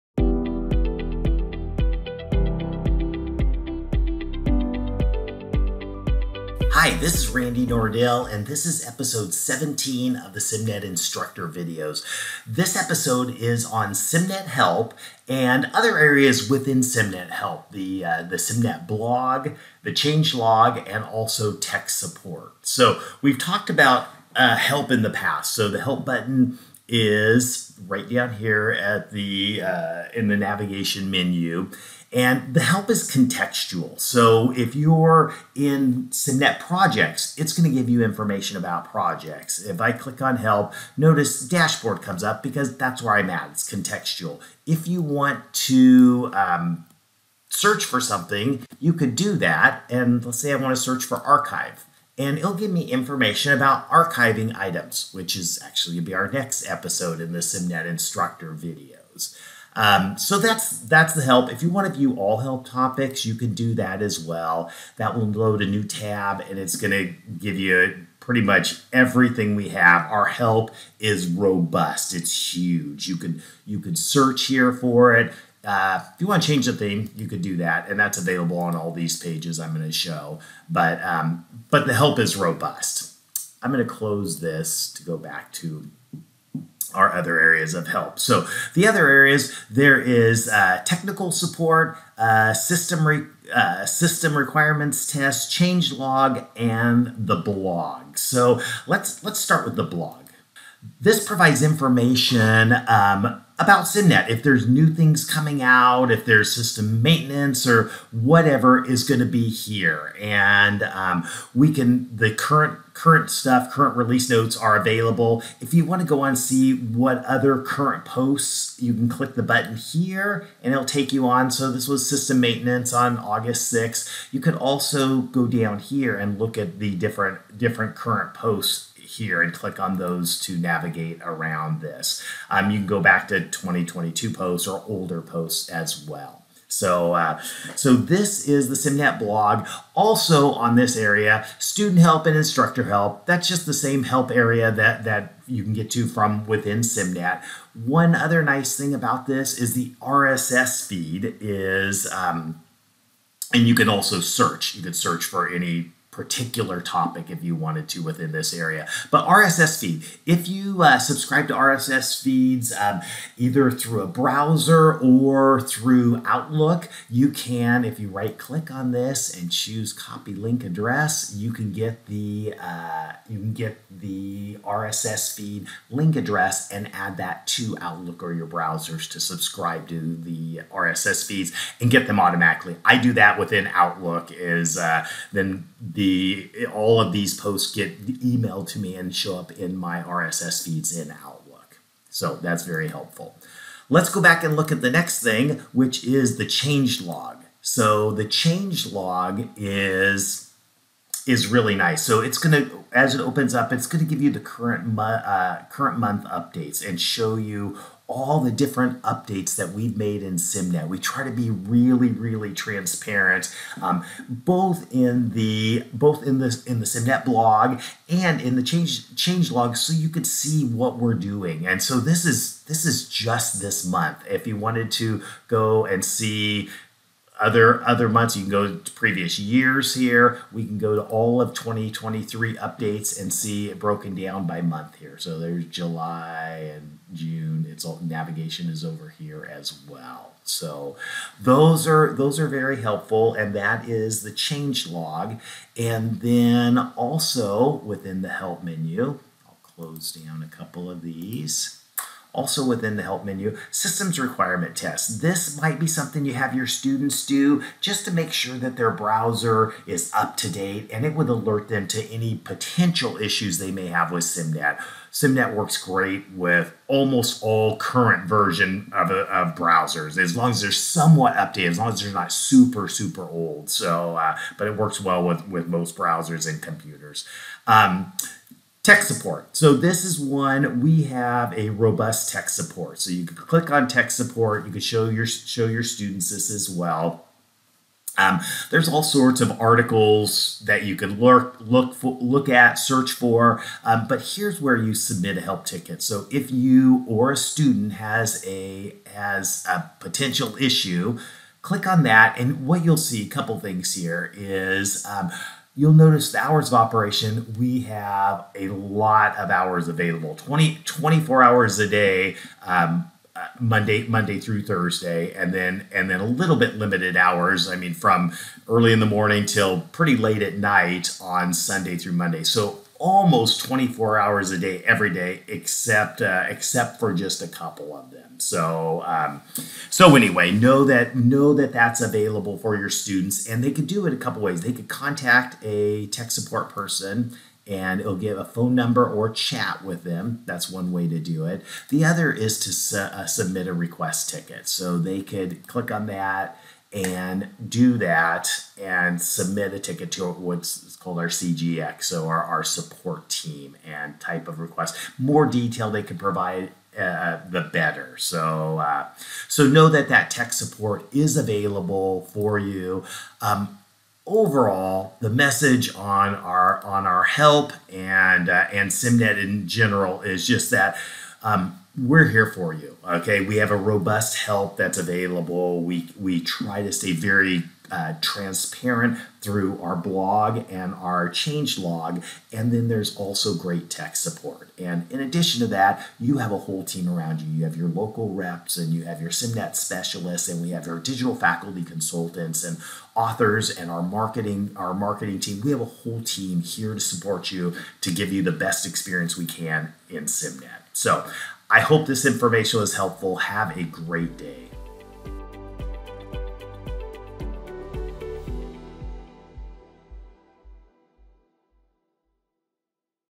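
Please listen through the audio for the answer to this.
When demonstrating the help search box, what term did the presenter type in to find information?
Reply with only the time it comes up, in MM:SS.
00:51.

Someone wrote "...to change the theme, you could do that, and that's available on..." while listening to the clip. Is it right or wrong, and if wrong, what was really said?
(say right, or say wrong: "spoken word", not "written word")
right.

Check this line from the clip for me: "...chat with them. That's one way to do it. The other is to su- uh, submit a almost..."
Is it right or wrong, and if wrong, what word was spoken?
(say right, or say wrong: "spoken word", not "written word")
wrong: "request", not "almost".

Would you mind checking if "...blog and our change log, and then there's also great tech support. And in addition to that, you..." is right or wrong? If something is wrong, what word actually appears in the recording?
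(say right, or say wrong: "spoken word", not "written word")
right.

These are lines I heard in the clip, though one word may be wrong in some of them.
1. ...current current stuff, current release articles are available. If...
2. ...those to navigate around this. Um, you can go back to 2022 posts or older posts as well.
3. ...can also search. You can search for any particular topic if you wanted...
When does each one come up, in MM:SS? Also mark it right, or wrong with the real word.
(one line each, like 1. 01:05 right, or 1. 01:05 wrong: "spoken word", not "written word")
1. 01:52 wrong: "notes", not "articles"
2. 02:09 right
3. 02:33 right.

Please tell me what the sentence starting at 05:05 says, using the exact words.
Um, you'll notice the hours of operation, we have a lot of hours available 20, 24 hours a day.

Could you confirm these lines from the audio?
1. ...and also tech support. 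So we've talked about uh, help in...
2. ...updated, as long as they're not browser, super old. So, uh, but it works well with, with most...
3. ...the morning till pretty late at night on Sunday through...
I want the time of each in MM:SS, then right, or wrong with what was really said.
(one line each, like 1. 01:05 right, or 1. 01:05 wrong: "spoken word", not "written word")
1. 00:20 right
2. 04:31 wrong: "super", not "browser"
3. 05:18 right.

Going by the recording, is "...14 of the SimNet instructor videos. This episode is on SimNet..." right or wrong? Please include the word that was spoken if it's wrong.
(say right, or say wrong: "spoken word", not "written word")
wrong: "17", not "14".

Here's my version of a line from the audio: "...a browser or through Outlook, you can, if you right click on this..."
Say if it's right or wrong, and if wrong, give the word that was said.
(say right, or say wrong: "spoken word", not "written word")
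right.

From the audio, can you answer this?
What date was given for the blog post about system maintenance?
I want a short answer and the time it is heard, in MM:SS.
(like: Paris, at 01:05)
August 6th, at 02:03.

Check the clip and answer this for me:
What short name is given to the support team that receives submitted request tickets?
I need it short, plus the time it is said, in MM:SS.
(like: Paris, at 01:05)
CXG, at 05:51.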